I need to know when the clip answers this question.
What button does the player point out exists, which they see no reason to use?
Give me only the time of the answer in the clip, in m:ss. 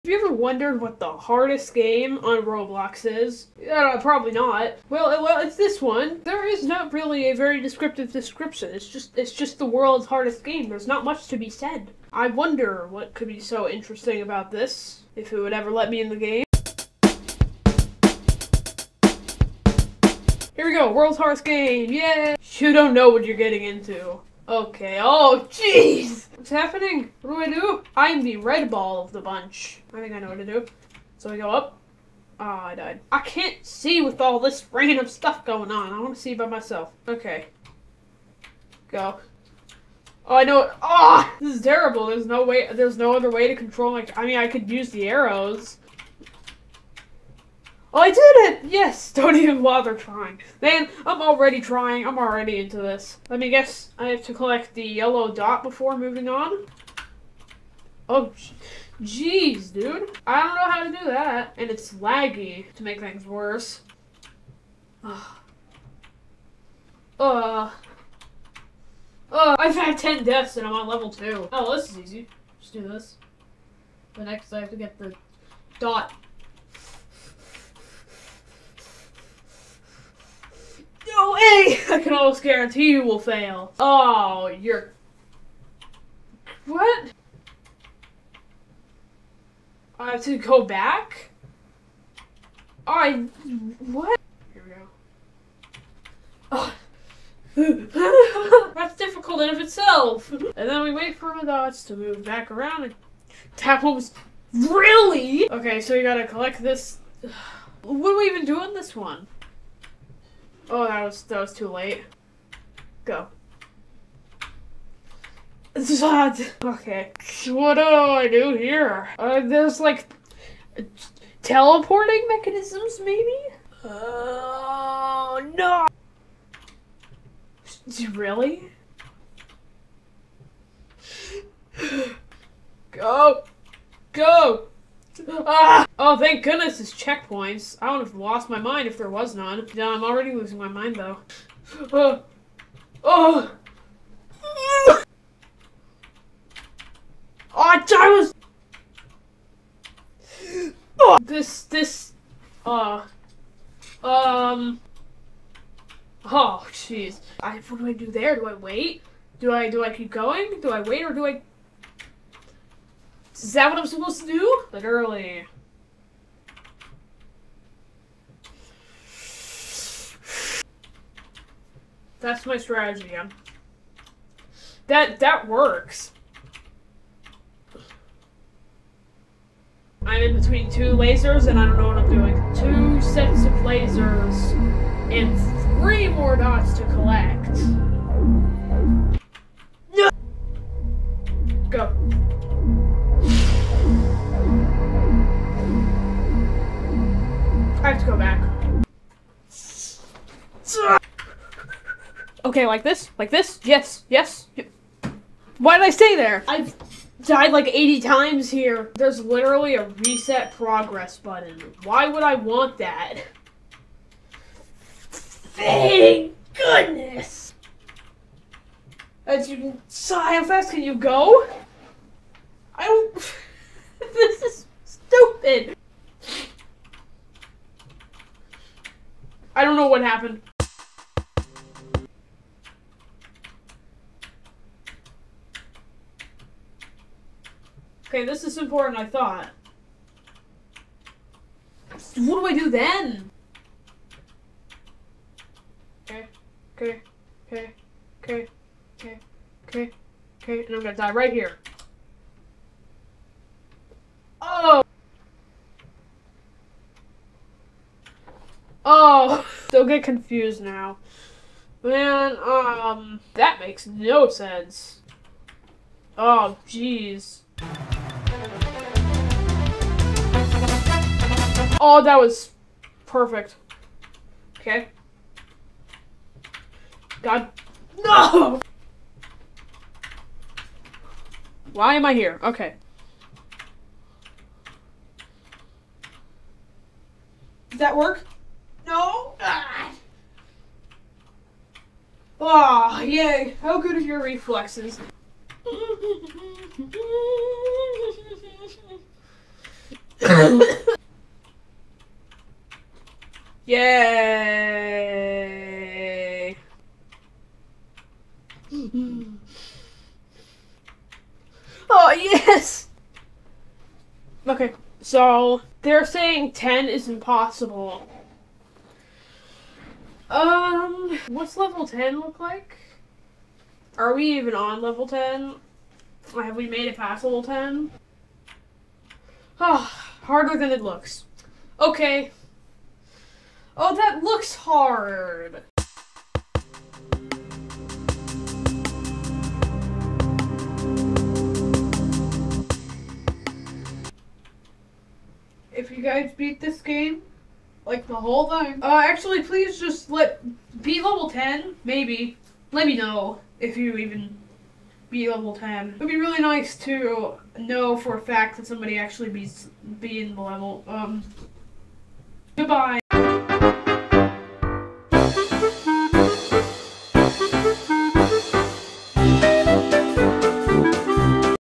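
3:29.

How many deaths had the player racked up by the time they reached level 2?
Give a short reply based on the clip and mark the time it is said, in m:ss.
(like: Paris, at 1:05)
10, at 1:09.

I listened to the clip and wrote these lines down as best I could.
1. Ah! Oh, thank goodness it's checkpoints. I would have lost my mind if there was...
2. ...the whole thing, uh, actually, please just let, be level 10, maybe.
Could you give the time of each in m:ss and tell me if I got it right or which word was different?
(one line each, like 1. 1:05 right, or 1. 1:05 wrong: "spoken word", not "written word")
1. 2:15 right
2. 5:48 right.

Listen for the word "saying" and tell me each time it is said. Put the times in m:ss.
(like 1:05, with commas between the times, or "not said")
5:16.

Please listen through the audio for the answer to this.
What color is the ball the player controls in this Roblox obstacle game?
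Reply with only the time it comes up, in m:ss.
0:28.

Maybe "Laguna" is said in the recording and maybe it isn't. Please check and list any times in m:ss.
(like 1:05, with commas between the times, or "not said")
not said.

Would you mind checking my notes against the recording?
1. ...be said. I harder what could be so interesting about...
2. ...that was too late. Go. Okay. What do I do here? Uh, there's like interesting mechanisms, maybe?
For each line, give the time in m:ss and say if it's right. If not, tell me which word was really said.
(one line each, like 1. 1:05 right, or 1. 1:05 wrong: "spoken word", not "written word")
1. 0:11 wrong: "wonder", not "harder"
2. 1:51 wrong: "teleporting", not "interesting".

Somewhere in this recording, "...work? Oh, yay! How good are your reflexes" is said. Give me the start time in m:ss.
4:47.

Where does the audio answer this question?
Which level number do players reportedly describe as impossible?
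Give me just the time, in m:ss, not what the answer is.
5:16.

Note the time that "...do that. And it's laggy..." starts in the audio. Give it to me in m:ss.
1:00.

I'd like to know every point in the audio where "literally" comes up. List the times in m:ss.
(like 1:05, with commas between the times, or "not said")
2:44, 3:29.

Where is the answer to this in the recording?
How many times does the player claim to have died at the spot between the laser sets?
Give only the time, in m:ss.
3:27.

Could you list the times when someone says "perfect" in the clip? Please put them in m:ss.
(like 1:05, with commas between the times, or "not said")
4:33.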